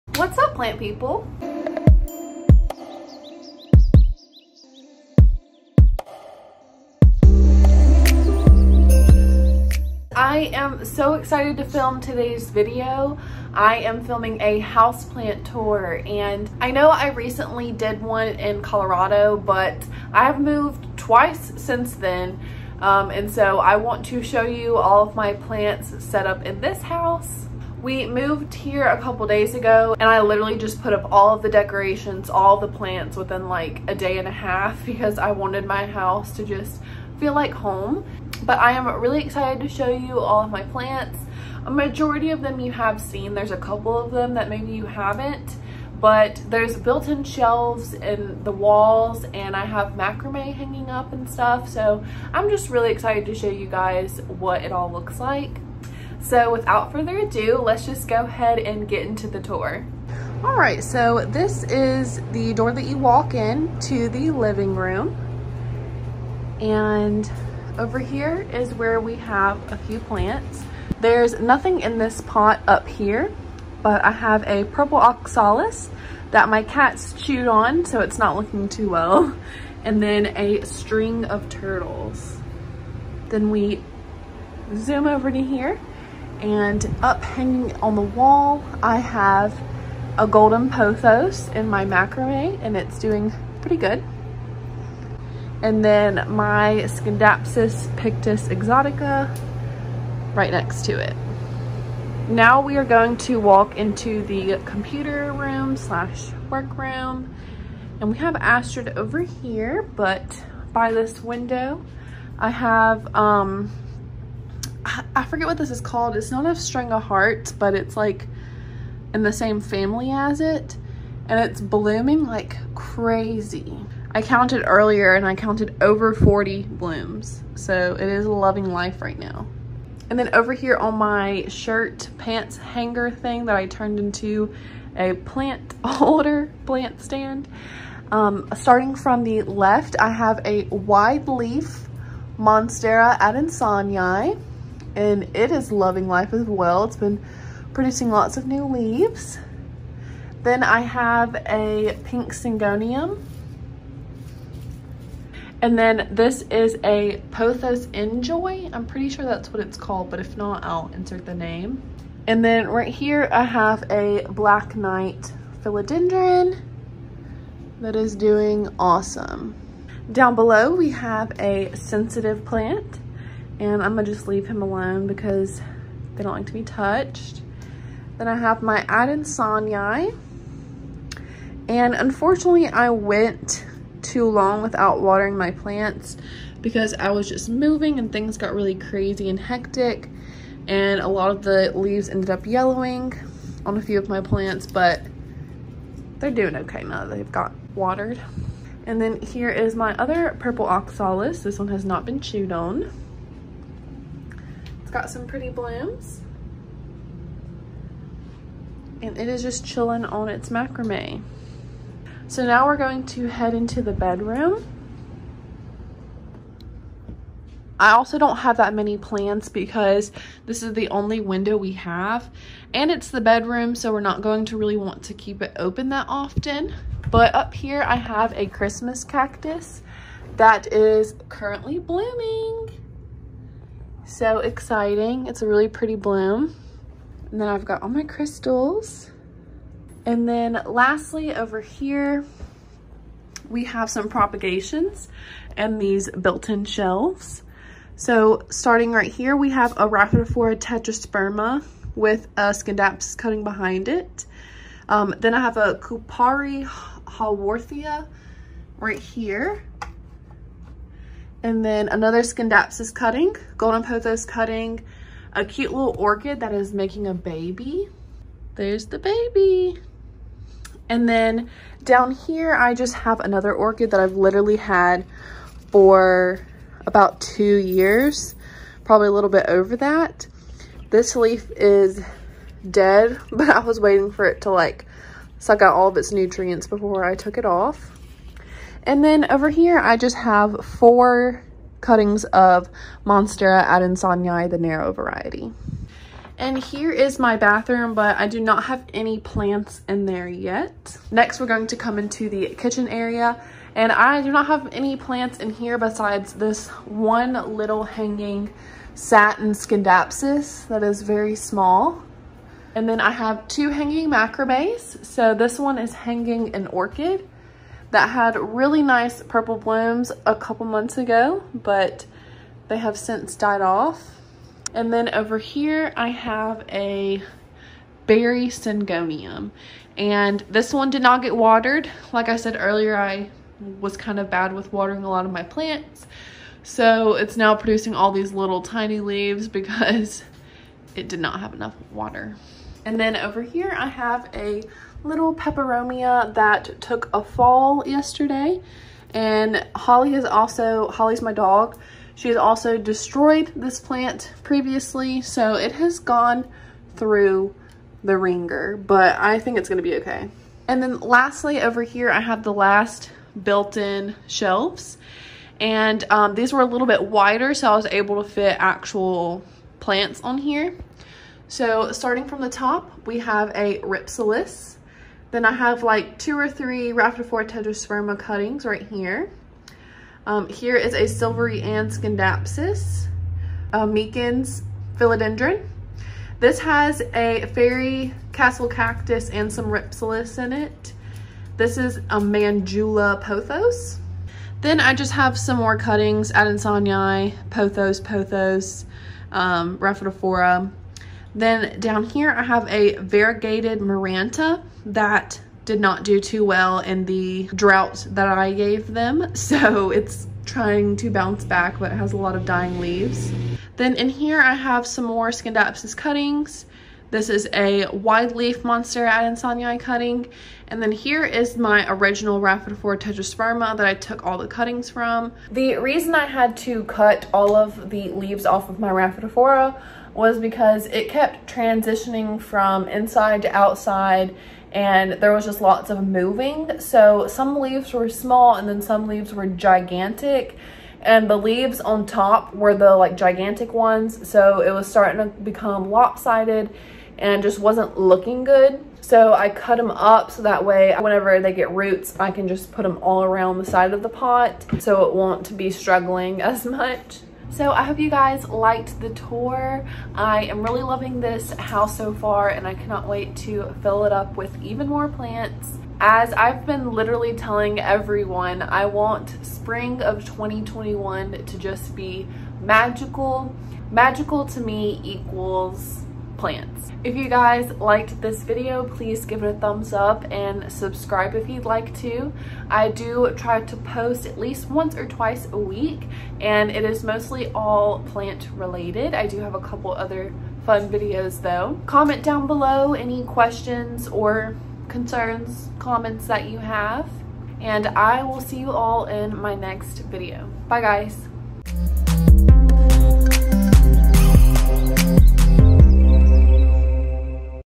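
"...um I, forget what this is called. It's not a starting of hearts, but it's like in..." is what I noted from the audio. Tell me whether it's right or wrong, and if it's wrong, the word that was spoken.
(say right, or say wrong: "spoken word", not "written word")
wrong: "string", not "starting".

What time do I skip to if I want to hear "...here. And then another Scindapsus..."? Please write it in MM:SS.
04:18.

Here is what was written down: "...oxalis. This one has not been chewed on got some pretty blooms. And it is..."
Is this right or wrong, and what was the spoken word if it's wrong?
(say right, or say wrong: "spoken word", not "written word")
right.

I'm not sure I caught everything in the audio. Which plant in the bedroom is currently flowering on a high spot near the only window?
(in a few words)
Christmas cactus.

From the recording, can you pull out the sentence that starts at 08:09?
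I do have a couple other fun videos though.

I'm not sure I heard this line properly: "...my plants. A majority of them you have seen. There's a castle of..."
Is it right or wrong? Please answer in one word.
wrong.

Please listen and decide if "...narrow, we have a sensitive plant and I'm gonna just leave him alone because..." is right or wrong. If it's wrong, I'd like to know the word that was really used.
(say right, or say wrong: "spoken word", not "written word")
wrong: "below", not "narrow".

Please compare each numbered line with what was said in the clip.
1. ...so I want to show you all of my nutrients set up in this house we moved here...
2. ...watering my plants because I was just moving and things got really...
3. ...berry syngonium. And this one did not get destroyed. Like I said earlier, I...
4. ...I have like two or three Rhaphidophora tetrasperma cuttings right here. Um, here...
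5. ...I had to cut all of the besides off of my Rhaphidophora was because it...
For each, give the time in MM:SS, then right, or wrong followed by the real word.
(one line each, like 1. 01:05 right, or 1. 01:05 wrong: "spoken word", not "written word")
1. 00:23 wrong: "plants", not "nutrients"
2. 03:04 right
3. 05:28 wrong: "watered", not "destroyed"
4. 06:15 right
5. 07:06 wrong: "leaves", not "besides".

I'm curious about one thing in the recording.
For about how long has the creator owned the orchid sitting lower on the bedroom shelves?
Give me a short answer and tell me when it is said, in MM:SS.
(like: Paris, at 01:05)
about two years, at 04:36.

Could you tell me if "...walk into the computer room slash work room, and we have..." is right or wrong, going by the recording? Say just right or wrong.
right.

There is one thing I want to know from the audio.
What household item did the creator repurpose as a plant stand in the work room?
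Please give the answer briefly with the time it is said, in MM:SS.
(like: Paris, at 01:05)
shirt pants hanger, at 02:11.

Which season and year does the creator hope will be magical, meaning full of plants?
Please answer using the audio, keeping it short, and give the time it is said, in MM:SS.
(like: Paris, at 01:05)
spring of 2021, at 07:49.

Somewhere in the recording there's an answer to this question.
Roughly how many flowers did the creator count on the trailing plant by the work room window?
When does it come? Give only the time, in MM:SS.
02:05.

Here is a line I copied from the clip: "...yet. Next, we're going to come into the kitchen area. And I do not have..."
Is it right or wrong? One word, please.
right.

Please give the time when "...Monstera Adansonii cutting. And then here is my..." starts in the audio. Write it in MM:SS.
06:58.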